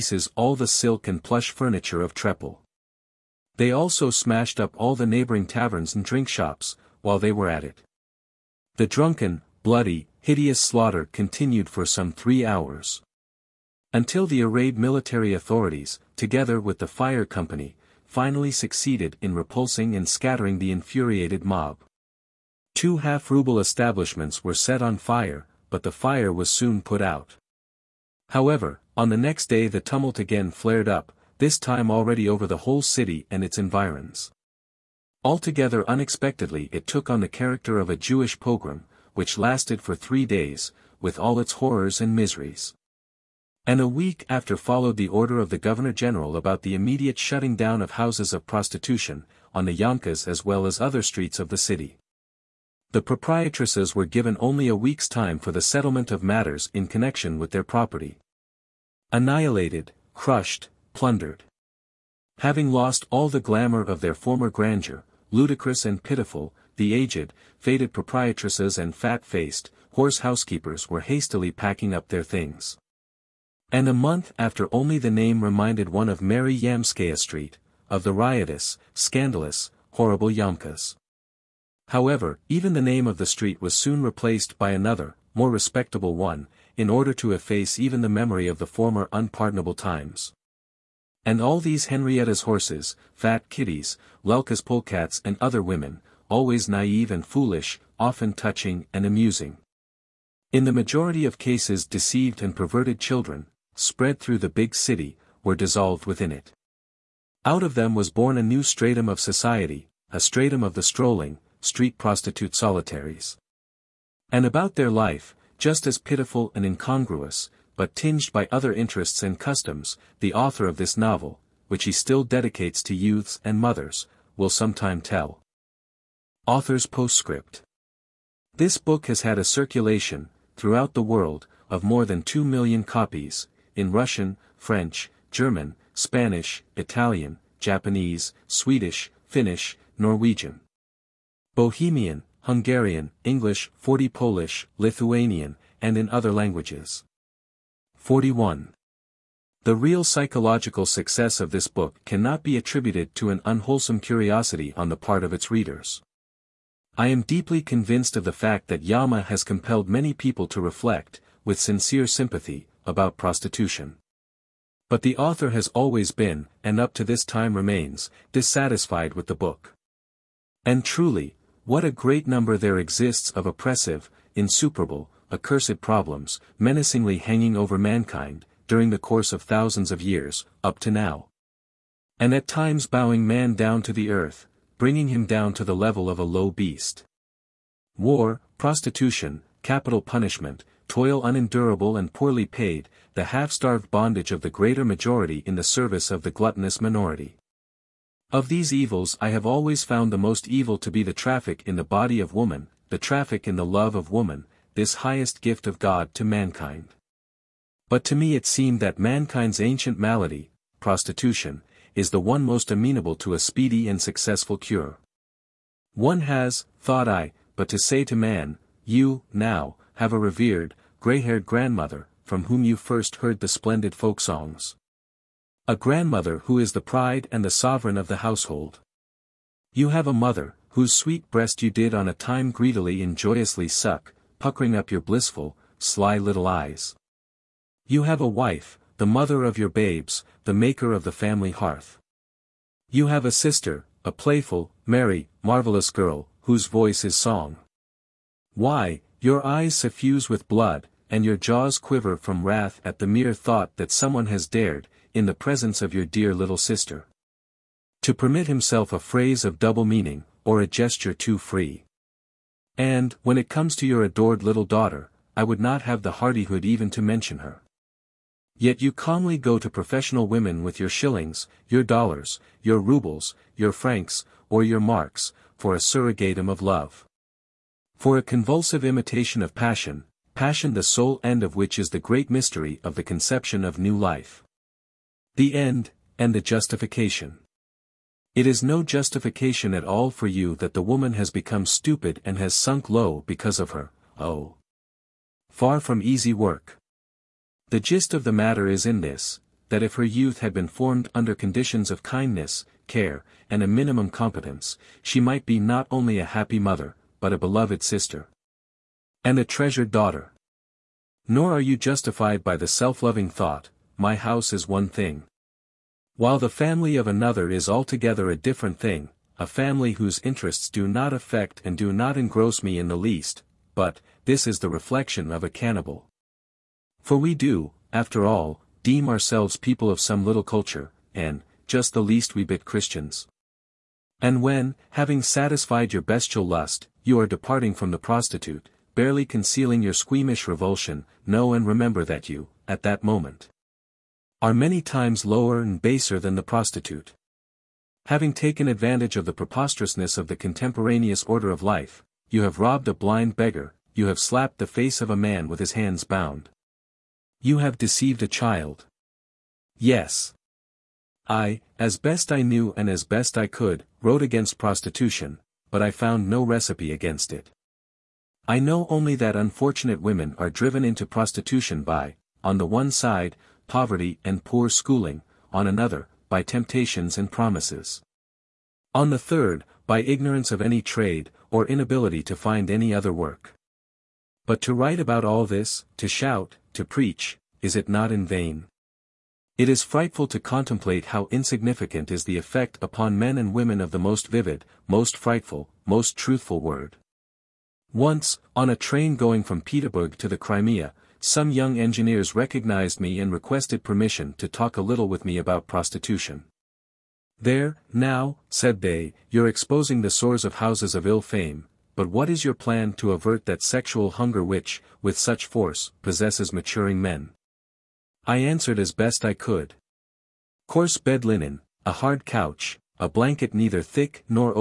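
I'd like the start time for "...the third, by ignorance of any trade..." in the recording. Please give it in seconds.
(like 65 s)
379 s.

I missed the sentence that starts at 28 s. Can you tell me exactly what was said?
However, on the next day the tumult again flared up, this time already over the whole city and its environs.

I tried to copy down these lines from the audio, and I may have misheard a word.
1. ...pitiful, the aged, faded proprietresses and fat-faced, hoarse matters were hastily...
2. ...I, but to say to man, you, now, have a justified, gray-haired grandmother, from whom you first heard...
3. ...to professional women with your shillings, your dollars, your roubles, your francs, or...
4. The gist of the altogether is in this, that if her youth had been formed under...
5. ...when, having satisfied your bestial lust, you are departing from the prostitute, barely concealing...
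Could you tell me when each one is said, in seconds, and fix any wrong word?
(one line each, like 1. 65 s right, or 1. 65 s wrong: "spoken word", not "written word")
1. 66 s wrong: "housekeepers", not "matters"
2. 217 s wrong: "revered", not "justified"
3. 269 s right
4. 297 s wrong: "matter", not "altogether"
5. 334 s right.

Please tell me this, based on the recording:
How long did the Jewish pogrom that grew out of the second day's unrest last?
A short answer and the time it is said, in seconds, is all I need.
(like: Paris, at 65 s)
3 days, at 39 s.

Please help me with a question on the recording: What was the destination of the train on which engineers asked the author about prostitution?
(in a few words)
the Crimea.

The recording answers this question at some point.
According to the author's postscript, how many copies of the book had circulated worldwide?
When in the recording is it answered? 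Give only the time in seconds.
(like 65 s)
131 s.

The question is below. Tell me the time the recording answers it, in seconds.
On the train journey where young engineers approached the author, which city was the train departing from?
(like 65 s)
399 s.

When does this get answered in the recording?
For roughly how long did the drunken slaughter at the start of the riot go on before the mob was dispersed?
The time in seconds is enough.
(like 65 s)
11 s.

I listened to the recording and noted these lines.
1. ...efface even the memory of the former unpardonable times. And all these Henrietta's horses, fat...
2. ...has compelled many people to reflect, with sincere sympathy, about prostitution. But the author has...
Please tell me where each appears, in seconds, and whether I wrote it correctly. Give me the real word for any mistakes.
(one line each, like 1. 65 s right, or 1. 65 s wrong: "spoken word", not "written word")
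1. 87 s right
2. 159 s right.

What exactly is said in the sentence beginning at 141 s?
Bohemian, Hungarian, English, 40 Polish, Lithuanian, and in other languages.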